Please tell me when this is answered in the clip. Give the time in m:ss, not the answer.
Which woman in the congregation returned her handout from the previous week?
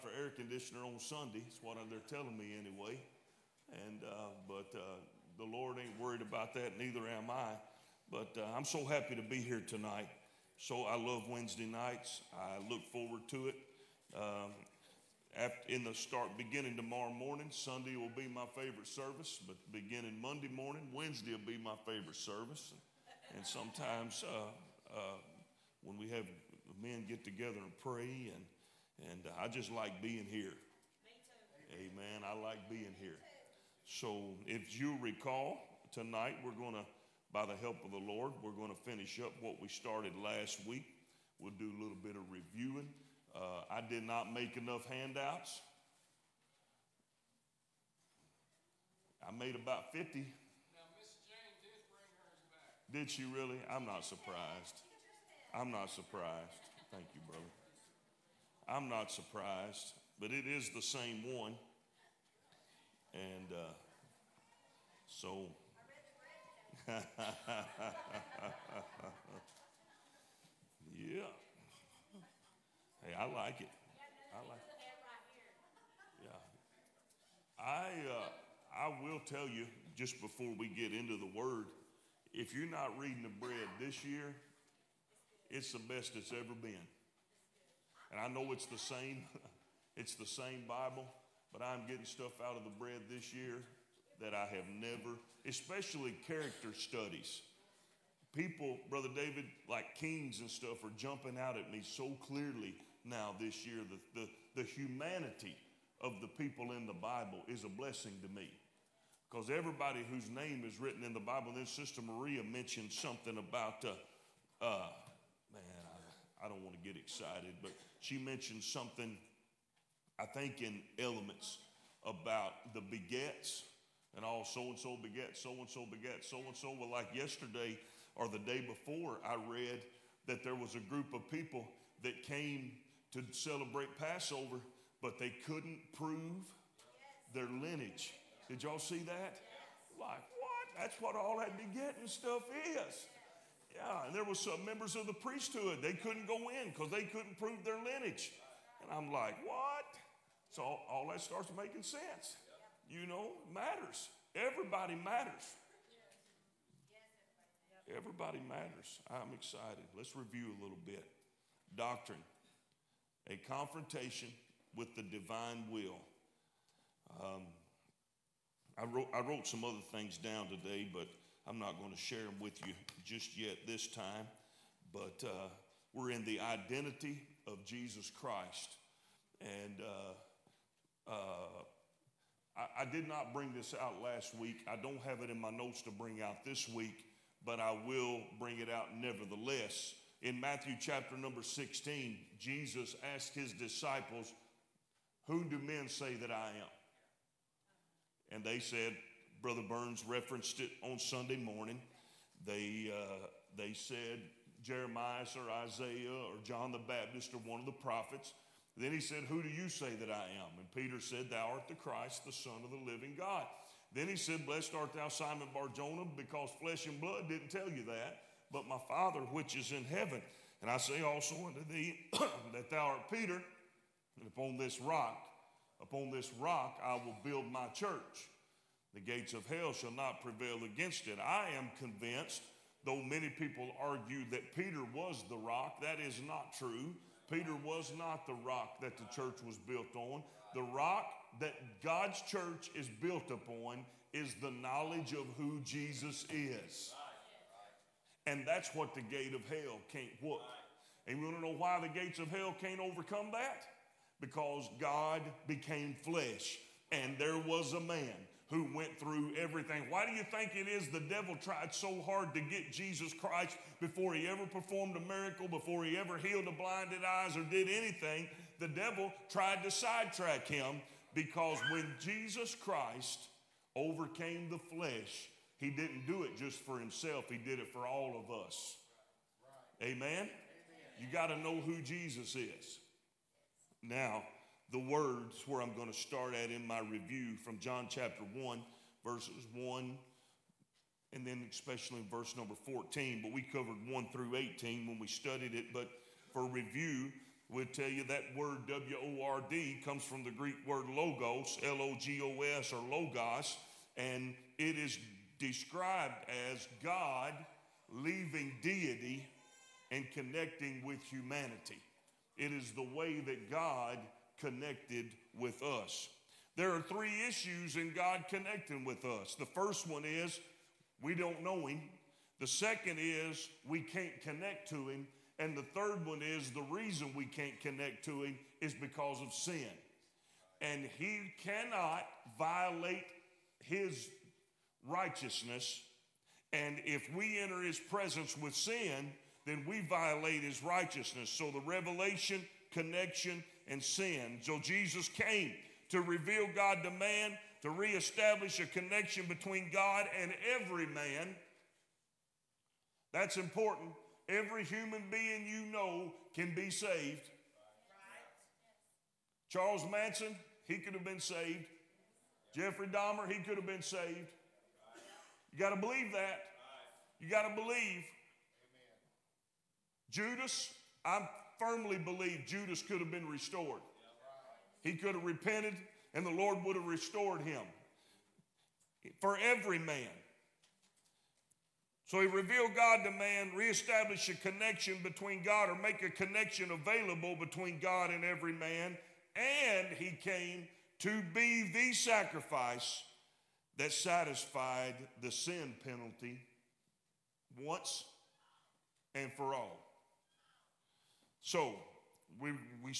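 0:50.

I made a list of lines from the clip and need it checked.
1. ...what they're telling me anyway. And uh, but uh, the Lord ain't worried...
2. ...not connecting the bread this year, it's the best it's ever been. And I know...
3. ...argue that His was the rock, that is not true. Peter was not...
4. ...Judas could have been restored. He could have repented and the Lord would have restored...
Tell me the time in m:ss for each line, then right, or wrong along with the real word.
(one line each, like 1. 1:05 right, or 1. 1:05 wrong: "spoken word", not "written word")
1. 0:01 right
2. 1:22 wrong: "reading", not "connecting"
3. 3:53 wrong: "Peter", not "His"
4. 6:12 right.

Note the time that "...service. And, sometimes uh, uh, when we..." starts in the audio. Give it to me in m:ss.
0:22.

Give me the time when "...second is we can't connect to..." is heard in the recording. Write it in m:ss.
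5:22.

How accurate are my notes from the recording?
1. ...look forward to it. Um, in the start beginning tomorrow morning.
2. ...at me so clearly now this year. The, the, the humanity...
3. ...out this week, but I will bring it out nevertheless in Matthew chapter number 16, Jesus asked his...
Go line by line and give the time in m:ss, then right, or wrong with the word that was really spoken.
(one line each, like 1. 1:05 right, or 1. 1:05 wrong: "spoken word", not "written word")
1. 0:12 right
2. 1:41 right
3. 3:06 right.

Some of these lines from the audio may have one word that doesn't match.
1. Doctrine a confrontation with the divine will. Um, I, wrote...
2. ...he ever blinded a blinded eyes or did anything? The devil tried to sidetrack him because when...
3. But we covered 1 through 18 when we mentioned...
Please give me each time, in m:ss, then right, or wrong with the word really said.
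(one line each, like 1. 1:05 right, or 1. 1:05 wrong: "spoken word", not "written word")
1. 2:41 right
2. 4:25 wrong: "healed", not "blinded"
3. 4:53 wrong: "studied", not "mentioned".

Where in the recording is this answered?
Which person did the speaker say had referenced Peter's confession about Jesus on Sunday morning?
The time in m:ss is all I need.
3:19.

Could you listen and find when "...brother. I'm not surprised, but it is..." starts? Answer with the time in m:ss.
0:57.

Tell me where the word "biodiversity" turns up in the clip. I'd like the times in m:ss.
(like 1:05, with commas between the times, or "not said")
not said.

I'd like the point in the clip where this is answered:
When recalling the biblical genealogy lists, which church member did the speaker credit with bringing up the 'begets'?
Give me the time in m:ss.
1:51.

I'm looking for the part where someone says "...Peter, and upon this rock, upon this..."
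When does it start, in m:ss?
3:43.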